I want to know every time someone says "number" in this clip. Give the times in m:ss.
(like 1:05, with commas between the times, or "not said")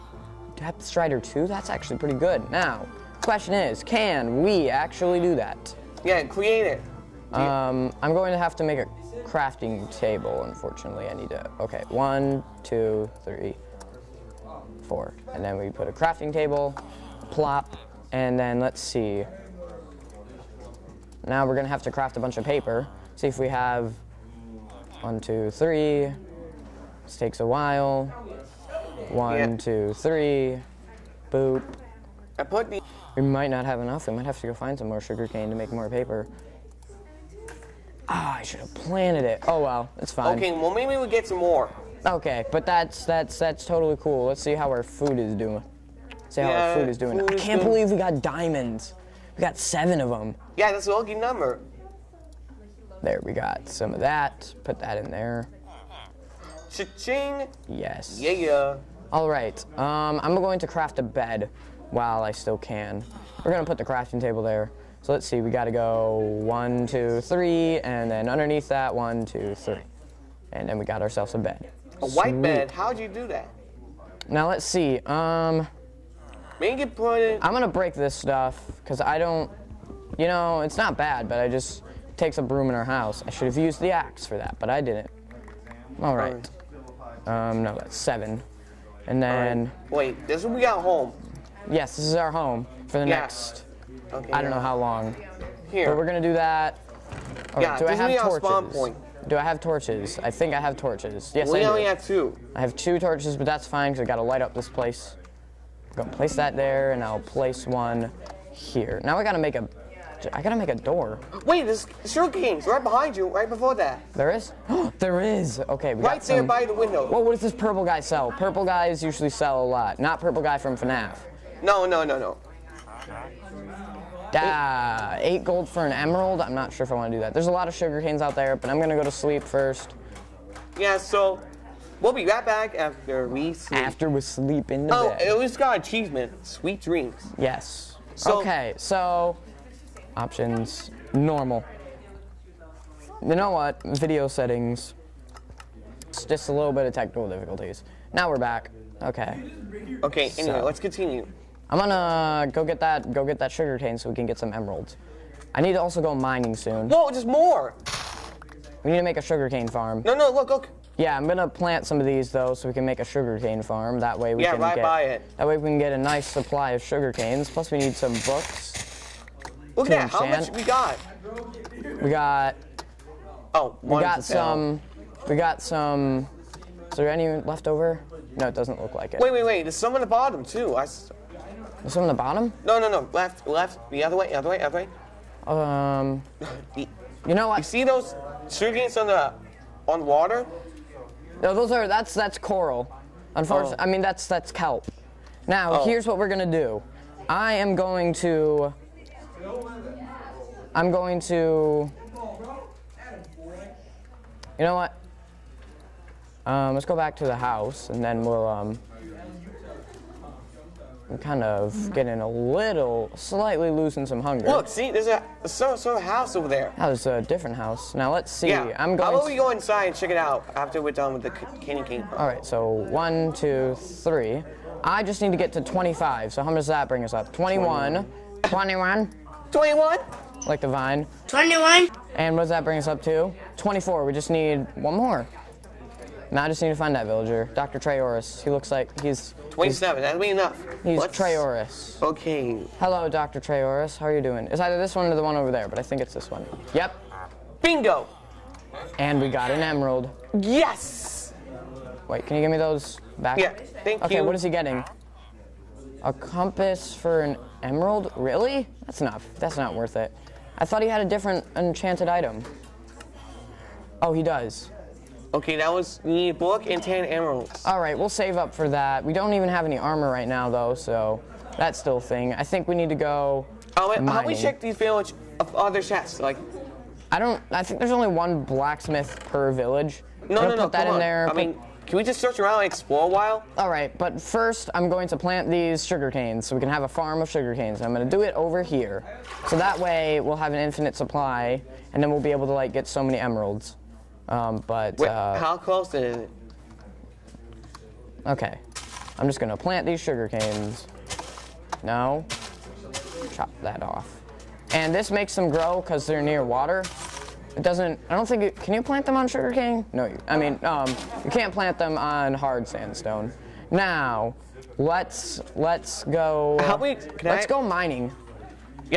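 0:51.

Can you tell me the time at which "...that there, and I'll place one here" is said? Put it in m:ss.
1:46.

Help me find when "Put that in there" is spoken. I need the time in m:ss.
0:54.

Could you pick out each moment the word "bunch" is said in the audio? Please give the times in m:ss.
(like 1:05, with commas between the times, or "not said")
0:22.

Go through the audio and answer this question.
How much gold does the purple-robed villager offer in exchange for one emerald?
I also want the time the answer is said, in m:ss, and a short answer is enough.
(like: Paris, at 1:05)
8 gold, at 2:05.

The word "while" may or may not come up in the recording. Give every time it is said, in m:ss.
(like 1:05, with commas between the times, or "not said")
0:27, 1:01, 4:43.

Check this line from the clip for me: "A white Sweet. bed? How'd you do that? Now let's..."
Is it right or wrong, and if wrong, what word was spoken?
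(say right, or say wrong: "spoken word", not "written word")
right.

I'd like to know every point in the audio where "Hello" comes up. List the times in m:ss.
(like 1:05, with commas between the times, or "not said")
4:02.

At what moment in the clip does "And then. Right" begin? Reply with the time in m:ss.
1:29.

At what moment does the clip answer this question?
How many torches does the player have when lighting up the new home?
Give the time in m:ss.
1:42.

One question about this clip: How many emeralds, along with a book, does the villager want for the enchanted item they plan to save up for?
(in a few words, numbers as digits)
10.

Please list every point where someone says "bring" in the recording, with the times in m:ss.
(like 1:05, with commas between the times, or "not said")
3:46, 3:52.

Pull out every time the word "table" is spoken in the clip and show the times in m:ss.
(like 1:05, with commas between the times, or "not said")
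0:09, 0:16, 1:04.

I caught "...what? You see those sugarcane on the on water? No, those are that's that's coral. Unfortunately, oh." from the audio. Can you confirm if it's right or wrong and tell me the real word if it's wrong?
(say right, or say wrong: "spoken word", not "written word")
right.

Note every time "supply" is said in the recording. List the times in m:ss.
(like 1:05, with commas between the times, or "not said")
2:46, 4:50.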